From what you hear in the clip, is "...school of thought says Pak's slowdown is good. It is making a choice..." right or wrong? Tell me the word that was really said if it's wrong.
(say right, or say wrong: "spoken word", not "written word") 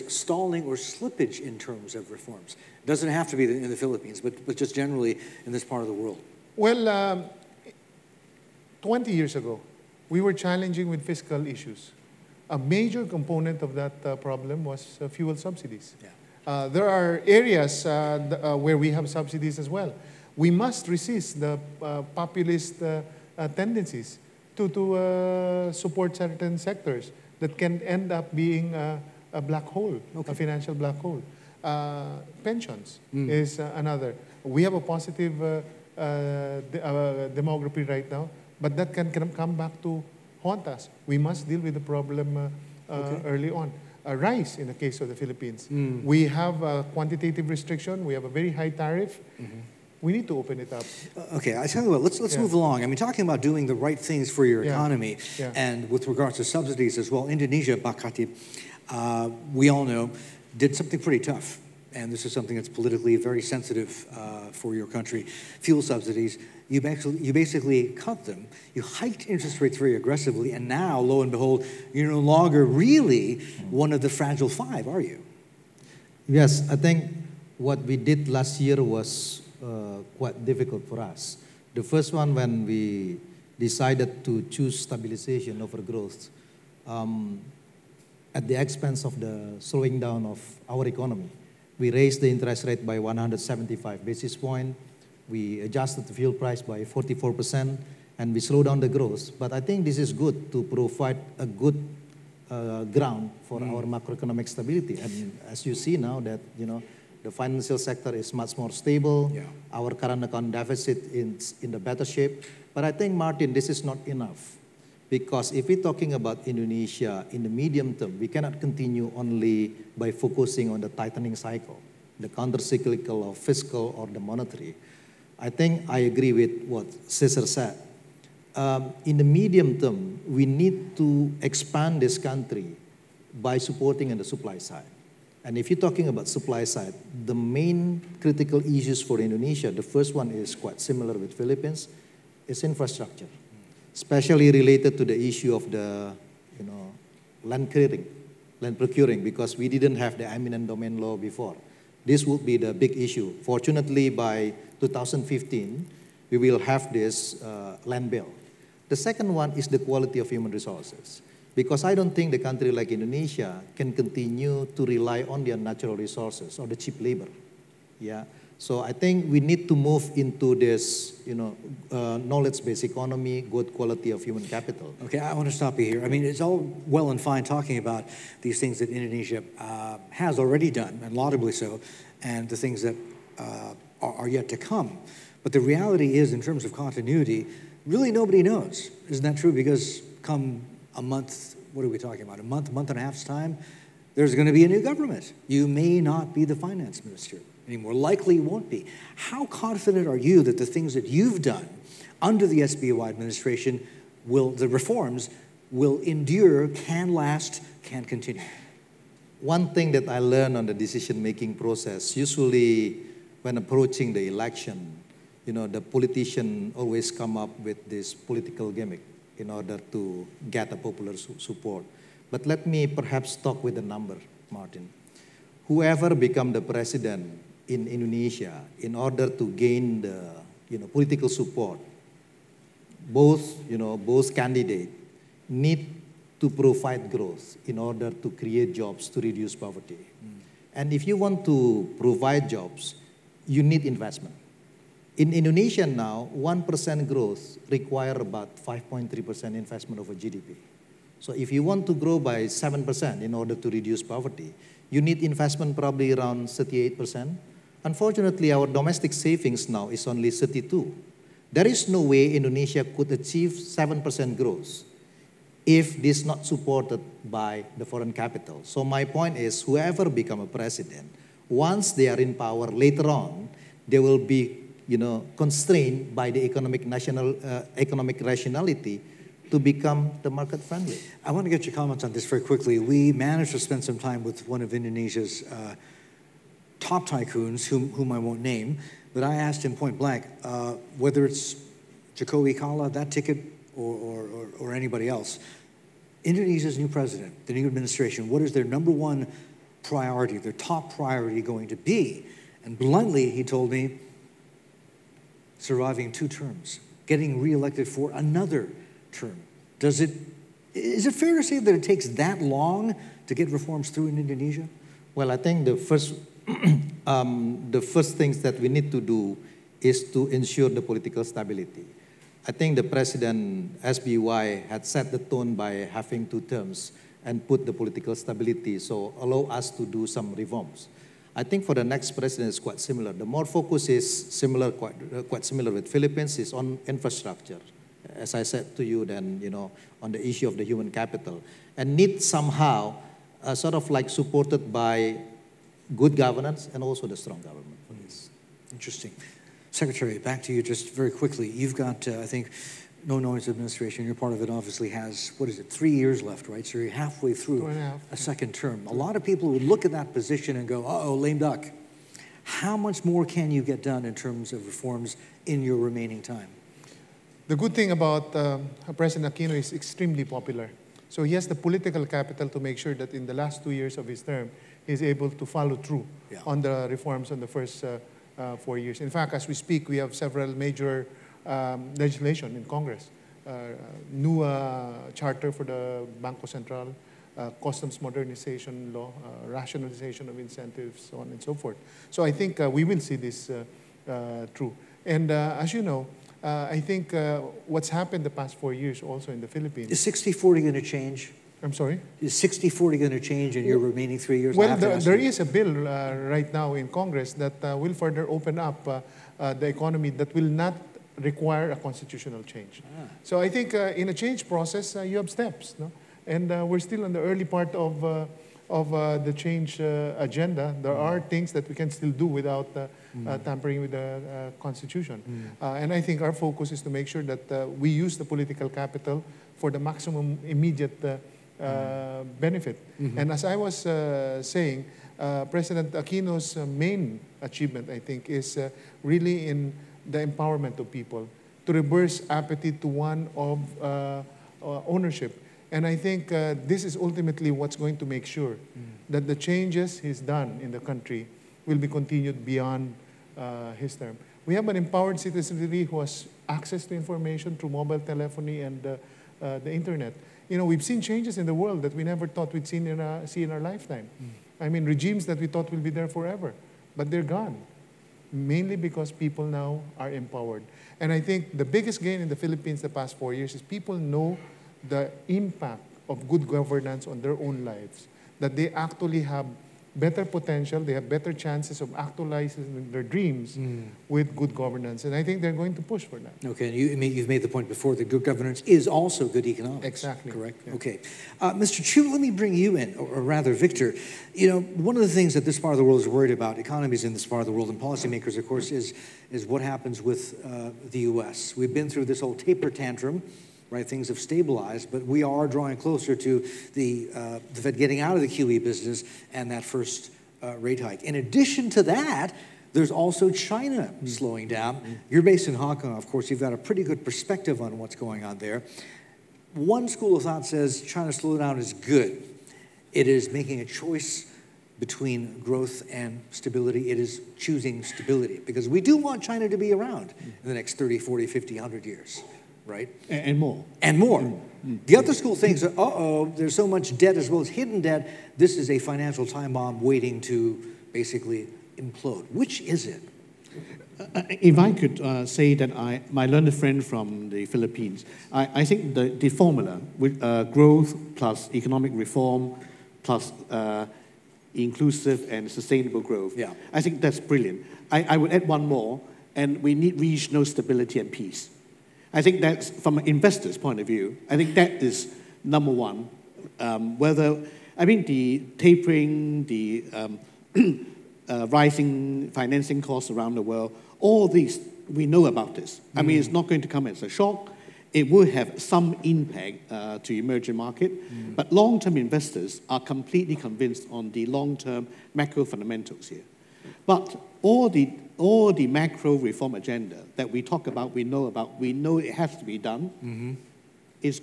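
wrong: "China", not "Pak".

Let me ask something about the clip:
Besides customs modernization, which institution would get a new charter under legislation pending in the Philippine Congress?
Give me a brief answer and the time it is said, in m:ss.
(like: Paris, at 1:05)
Banco Central, at 6:26.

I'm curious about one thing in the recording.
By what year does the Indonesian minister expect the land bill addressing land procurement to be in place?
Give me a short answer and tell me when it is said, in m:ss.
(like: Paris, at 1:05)
2015, at 2:34.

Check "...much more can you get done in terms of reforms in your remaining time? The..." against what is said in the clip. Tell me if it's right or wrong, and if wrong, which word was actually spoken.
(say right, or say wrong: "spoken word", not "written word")
right.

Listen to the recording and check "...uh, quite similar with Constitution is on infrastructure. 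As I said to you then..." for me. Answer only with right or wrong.
wrong.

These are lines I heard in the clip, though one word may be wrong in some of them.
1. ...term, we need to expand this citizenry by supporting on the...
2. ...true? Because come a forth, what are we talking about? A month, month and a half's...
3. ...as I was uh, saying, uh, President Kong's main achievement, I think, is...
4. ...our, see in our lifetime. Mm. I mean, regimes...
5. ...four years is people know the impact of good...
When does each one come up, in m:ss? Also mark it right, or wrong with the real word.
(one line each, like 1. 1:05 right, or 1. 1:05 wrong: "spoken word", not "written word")
1. 2:09 wrong: "country", not "citizenry"
2. 3:09 wrong: "month", not "forth"
3. 7:13 wrong: "Aquino", not "Kong"
4. 7:43 right
5. 7:53 right.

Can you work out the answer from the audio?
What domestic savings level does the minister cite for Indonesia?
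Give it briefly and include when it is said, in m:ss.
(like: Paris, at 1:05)
32, at 4:20.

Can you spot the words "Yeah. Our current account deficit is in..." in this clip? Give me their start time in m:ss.
1:49.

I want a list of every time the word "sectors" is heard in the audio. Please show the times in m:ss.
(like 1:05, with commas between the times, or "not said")
0:26, 1:47.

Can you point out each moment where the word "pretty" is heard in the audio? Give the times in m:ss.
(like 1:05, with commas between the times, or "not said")
1:00, 8:36.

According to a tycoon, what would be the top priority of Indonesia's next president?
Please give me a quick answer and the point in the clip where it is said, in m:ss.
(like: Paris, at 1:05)
surviving two terms, at 5:05.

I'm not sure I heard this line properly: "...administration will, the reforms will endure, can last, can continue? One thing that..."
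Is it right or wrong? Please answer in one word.
right.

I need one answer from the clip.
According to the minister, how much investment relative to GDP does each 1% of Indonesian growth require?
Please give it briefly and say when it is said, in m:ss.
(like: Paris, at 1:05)
5.3%, at 4:08.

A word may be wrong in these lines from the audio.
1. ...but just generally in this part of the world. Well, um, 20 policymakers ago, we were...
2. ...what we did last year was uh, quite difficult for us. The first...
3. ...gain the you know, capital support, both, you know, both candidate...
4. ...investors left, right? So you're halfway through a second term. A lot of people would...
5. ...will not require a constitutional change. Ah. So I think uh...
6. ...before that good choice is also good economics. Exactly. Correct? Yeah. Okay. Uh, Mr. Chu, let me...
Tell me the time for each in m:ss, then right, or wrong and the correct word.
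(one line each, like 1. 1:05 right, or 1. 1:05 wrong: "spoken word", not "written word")
1. 0:04 wrong: "years", not "policymakers"
2. 1:17 right
3. 3:49 wrong: "political", not "capital"
4. 5:55 wrong: "years", not "investors"
5. 6:50 right
6. 8:07 wrong: "governance", not "choice".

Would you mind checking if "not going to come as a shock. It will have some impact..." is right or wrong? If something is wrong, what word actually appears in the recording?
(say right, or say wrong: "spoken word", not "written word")
right.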